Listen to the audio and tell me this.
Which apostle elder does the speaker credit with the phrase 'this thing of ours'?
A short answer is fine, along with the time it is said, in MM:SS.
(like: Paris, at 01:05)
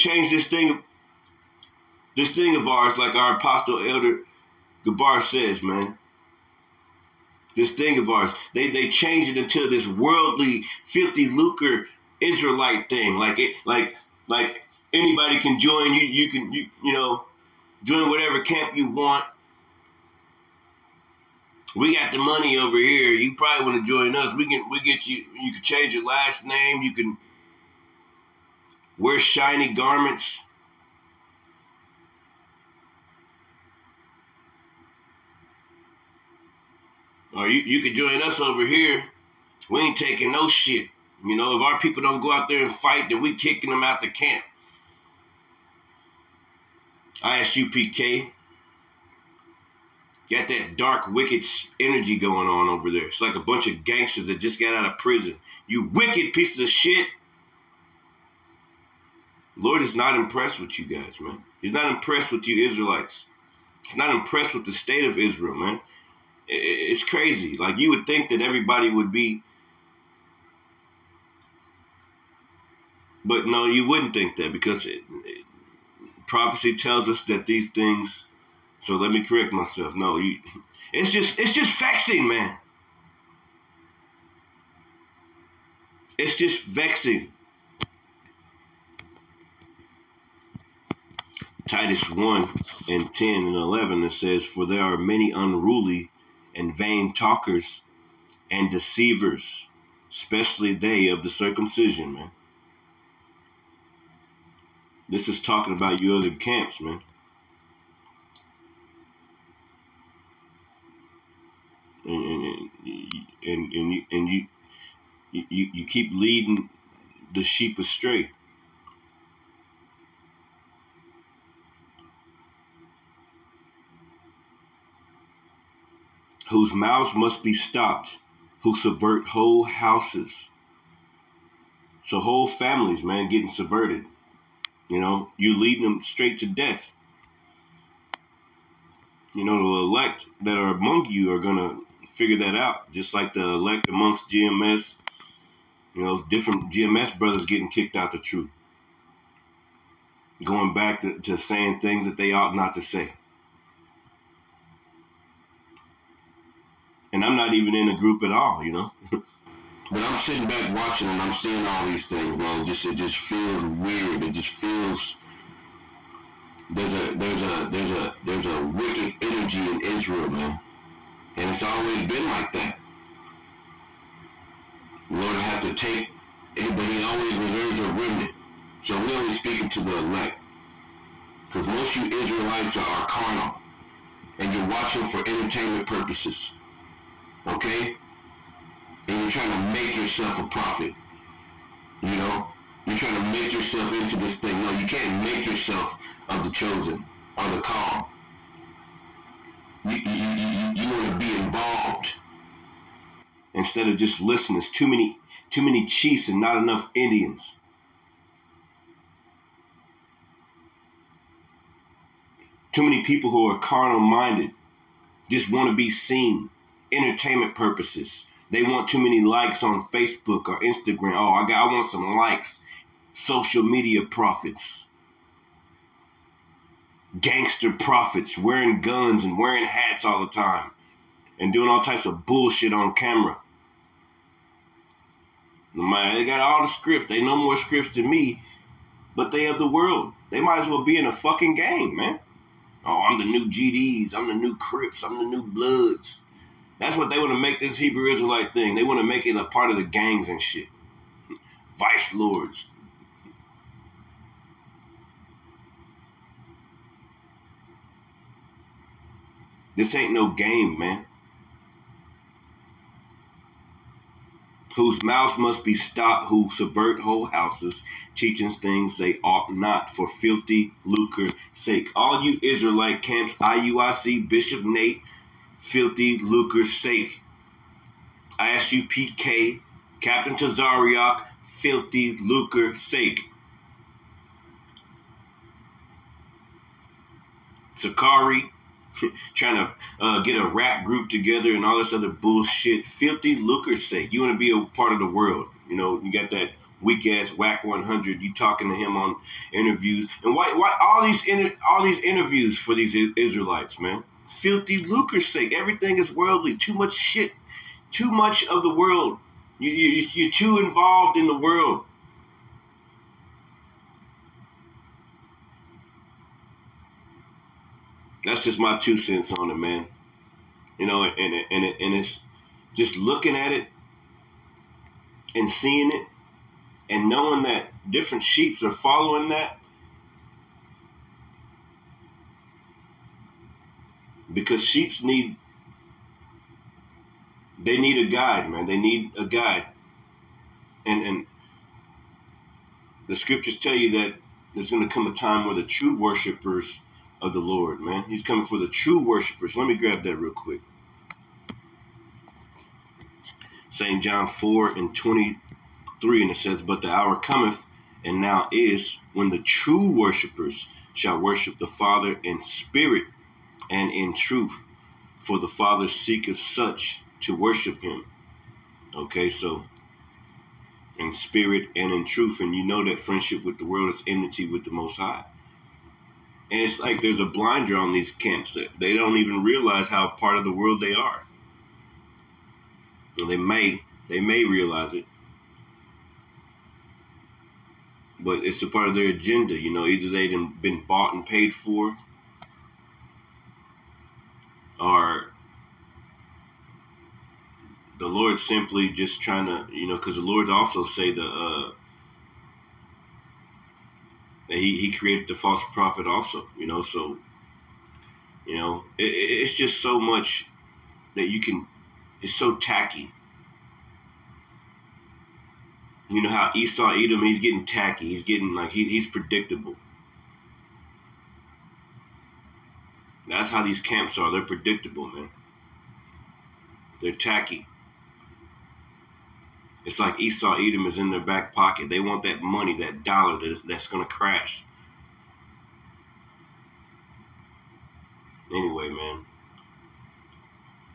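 Gabar, at 00:04.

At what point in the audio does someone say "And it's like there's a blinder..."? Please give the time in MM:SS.
06:16.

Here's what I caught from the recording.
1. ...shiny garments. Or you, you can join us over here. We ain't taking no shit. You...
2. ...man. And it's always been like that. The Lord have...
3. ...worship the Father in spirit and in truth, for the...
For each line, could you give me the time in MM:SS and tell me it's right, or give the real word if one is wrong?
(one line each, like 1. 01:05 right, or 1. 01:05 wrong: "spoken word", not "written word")
1. 00:29 right
2. 02:50 right
3. 06:01 right.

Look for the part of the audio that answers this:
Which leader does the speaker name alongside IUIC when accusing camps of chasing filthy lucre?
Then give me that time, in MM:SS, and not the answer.
04:34.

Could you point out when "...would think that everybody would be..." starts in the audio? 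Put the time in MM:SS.
01:07.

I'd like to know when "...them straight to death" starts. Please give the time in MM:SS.
02:15.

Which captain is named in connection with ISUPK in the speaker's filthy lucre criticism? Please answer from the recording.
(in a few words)
Captain Tazaryach.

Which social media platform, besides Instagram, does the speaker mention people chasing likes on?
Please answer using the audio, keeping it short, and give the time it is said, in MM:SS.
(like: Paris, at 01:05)
Facebook, at 03:39.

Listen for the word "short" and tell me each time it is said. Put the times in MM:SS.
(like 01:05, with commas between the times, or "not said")
not said.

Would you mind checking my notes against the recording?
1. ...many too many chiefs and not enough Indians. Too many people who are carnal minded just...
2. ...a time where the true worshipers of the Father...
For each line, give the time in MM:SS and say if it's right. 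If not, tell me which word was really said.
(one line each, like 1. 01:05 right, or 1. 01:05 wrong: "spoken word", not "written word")
1. 03:24 right
2. 05:45 wrong: "Lord", not "Father".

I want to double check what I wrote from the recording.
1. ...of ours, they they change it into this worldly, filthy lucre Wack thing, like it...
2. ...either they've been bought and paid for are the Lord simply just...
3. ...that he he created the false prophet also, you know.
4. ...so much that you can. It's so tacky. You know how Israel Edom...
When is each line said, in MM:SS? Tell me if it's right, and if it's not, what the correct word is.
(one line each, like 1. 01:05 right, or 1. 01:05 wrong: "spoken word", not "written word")
1. 00:07 wrong: "Israelite", not "Wack"
2. 06:29 right
3. 06:44 right
4. 06:49 wrong: "Esau", not "Israel".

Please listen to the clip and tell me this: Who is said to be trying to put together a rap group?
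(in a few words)
Sakari.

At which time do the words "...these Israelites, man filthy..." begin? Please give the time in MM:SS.
05:02.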